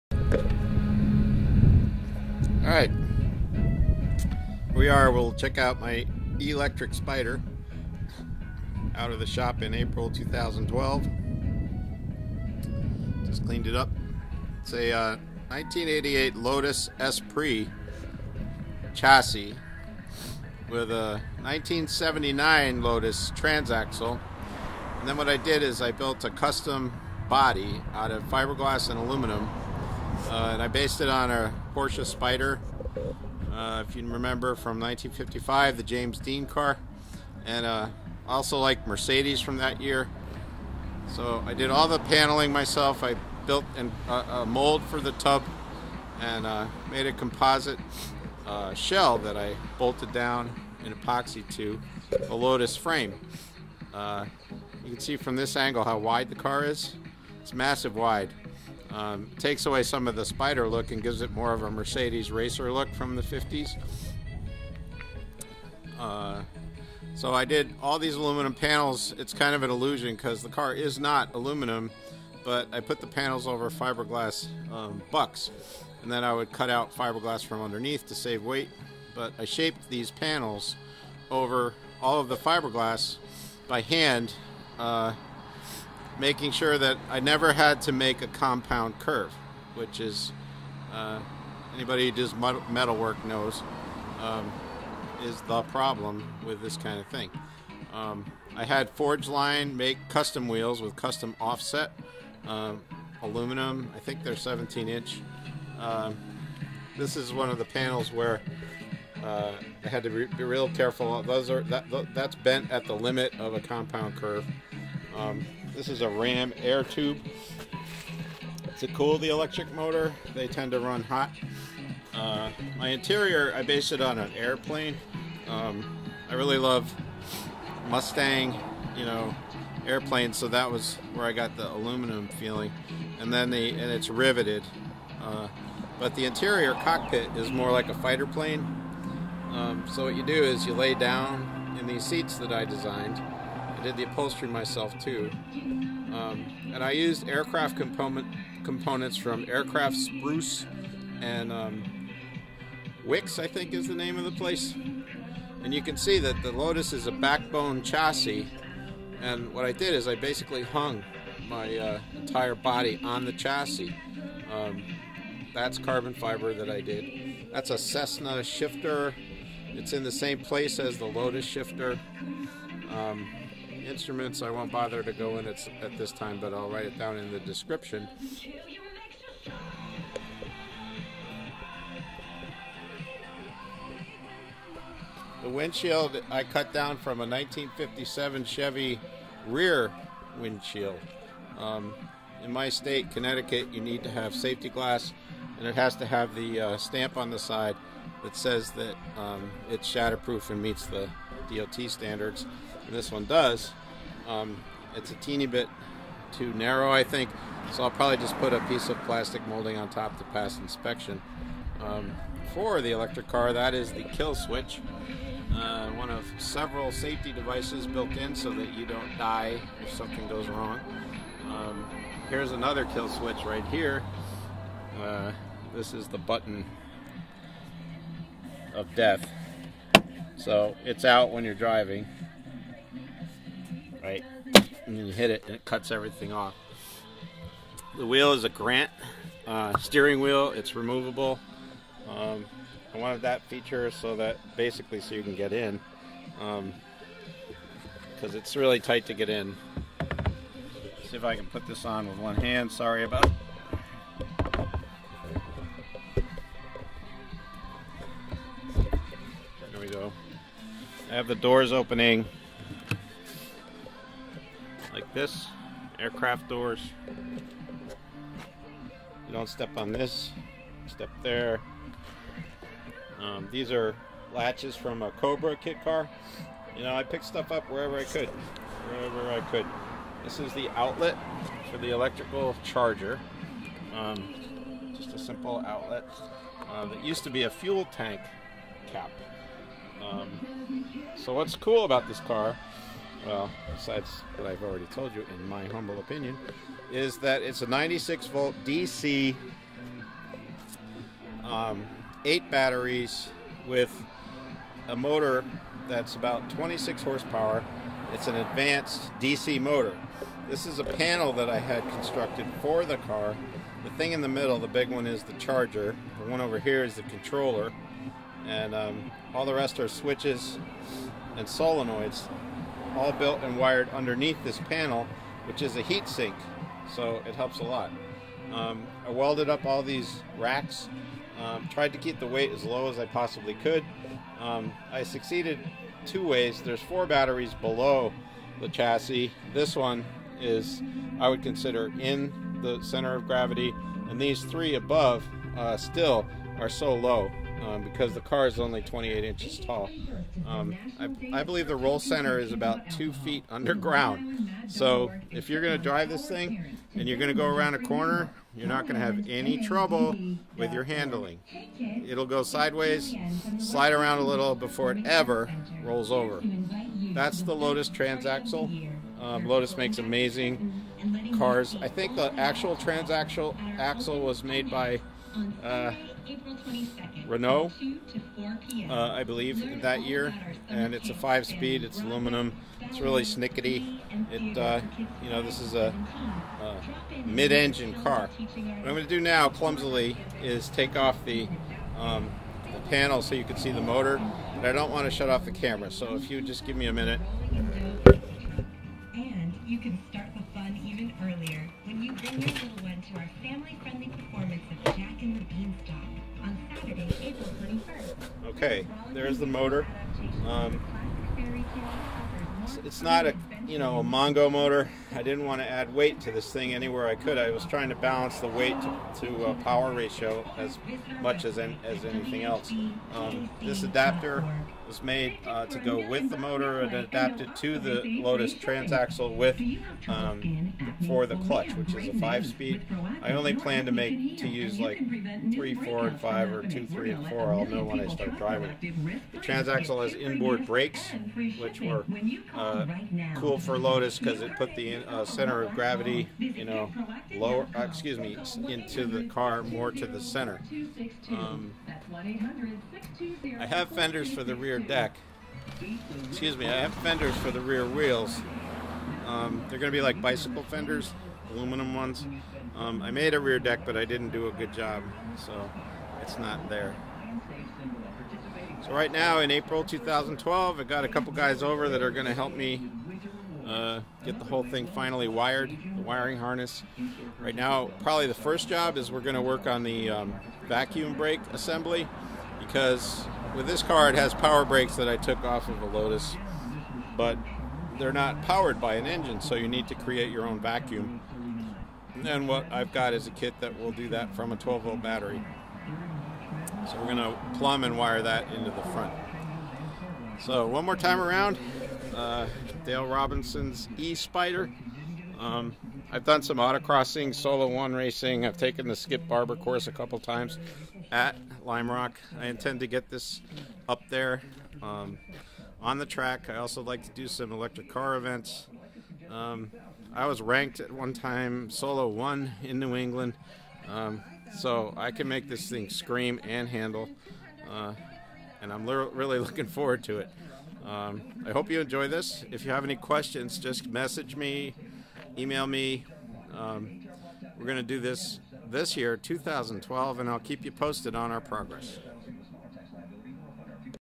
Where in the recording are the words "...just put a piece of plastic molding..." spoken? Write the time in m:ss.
3:28.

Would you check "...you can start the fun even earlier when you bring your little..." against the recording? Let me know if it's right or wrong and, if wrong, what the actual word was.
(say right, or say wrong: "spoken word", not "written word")
right.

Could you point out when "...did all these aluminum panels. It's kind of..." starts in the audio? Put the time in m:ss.
1:07.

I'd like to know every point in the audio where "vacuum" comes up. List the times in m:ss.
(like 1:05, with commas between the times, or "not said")
8:00, 8:10.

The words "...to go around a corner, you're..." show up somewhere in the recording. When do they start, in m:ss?
5:57.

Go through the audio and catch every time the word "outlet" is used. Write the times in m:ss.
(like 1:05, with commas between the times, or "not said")
4:40, 4:45.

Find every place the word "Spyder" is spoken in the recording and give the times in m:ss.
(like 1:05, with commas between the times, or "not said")
0:32, 8:24.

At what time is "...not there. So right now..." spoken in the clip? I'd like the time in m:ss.
7:46.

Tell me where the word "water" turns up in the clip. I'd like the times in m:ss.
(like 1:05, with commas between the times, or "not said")
not said.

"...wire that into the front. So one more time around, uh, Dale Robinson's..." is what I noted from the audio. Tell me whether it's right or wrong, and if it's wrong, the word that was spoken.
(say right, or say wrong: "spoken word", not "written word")
right.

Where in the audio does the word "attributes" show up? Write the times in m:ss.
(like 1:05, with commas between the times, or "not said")
not said.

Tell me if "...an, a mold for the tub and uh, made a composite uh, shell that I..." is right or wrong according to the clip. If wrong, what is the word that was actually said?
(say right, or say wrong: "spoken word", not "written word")
right.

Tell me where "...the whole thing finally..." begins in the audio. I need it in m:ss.
7:54.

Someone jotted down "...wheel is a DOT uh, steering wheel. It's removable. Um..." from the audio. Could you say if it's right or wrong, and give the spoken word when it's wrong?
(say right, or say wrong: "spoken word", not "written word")
wrong: "Grant", not "DOT".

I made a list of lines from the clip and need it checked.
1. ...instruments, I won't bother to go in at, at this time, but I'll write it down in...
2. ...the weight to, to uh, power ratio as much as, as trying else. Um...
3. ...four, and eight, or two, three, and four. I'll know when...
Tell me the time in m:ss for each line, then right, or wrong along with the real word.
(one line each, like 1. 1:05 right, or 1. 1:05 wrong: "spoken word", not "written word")
1. 2:53 right
2. 6:58 wrong: "anything", not "trying"
3. 7:15 wrong: "five", not "eight".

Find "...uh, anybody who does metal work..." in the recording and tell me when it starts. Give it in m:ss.
1:30.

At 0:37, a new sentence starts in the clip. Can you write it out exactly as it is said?
And uh, also like Mercedes from that year.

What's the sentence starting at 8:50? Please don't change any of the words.
Um, I hope you enjoy this.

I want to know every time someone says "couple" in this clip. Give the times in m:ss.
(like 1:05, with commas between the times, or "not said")
7:51, 8:29.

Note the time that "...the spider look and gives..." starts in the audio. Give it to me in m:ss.
1:00.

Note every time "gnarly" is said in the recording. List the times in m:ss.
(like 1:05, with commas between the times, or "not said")
not said.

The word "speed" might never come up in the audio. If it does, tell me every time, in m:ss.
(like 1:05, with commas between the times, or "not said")
6:21, 7:12.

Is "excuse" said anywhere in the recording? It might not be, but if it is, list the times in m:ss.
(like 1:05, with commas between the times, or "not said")
7:27, 7:36.